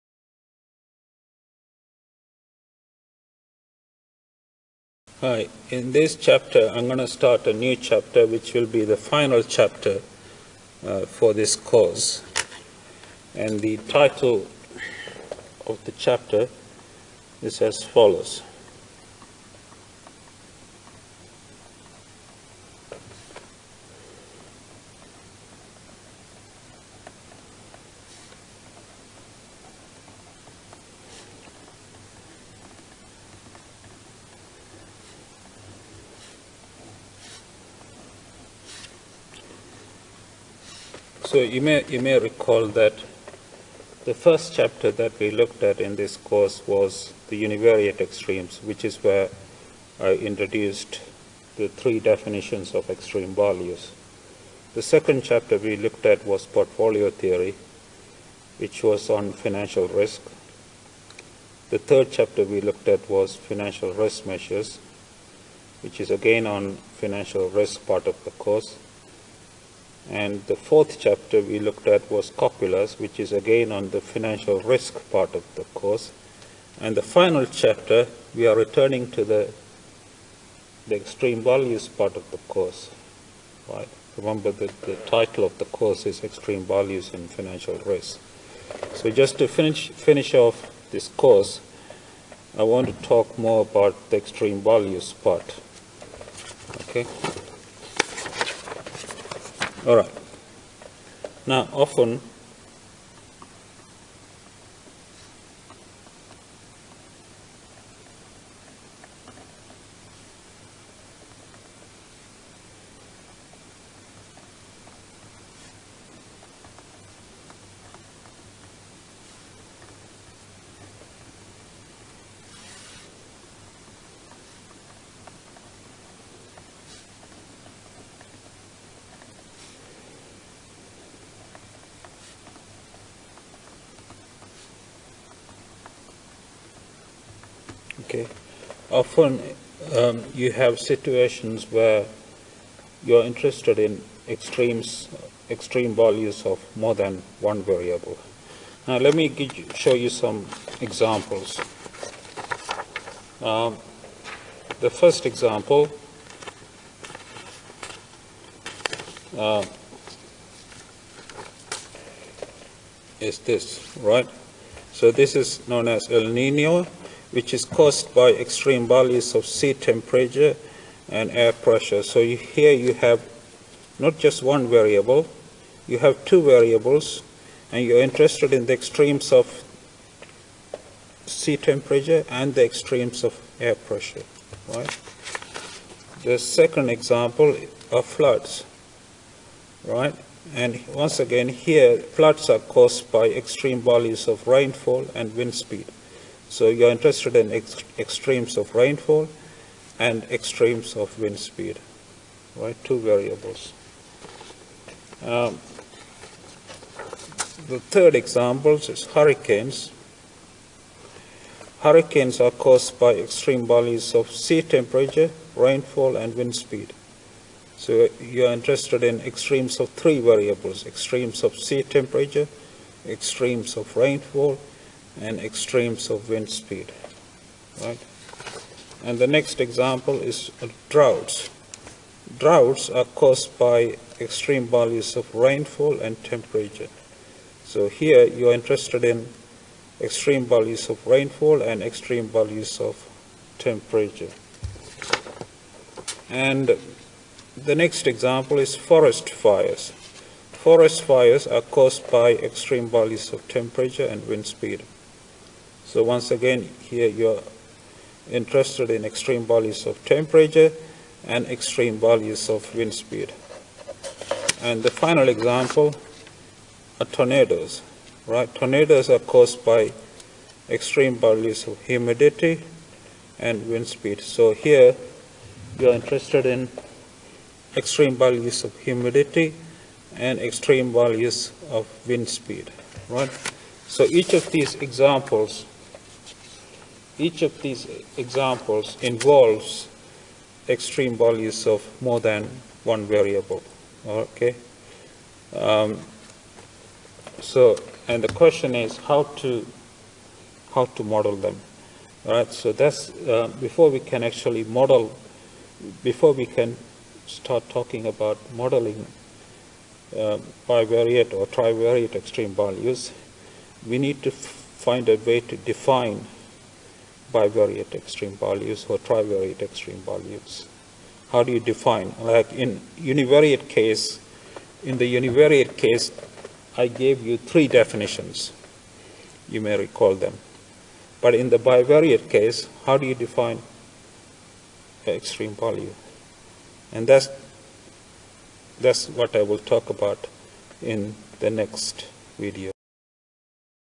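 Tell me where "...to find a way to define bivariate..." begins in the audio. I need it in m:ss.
5:14.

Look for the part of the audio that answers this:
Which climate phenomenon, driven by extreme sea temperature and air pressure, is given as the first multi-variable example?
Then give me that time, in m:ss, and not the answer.
2:46.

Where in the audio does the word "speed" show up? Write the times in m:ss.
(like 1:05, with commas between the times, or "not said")
3:15, 3:21, 3:36, 3:46, 4:14, 4:22, 4:33, 4:42.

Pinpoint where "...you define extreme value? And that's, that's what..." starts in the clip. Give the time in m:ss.
5:33.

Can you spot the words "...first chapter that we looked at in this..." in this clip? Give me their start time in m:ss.
0:44.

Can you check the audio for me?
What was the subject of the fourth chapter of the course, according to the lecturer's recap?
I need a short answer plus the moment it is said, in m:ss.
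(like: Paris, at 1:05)
Copulas, at 1:12.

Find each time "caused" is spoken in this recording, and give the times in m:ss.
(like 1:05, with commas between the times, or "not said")
2:47, 3:12, 3:32, 3:53, 4:11, 4:29.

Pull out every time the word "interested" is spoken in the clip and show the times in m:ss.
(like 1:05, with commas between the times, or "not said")
2:23, 2:58, 3:16, 3:38, 3:58, 4:18, 4:35.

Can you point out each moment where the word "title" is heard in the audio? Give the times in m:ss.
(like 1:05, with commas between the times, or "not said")
0:13, 1:25.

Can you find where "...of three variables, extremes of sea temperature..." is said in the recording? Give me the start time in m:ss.
3:39.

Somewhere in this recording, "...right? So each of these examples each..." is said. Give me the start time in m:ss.
4:43.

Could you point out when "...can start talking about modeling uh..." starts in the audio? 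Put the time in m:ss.
5:06.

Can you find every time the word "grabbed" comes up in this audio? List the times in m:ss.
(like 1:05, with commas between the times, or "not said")
not said.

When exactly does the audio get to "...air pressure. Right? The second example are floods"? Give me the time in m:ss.
3:03.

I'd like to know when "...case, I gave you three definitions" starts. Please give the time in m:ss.
5:25.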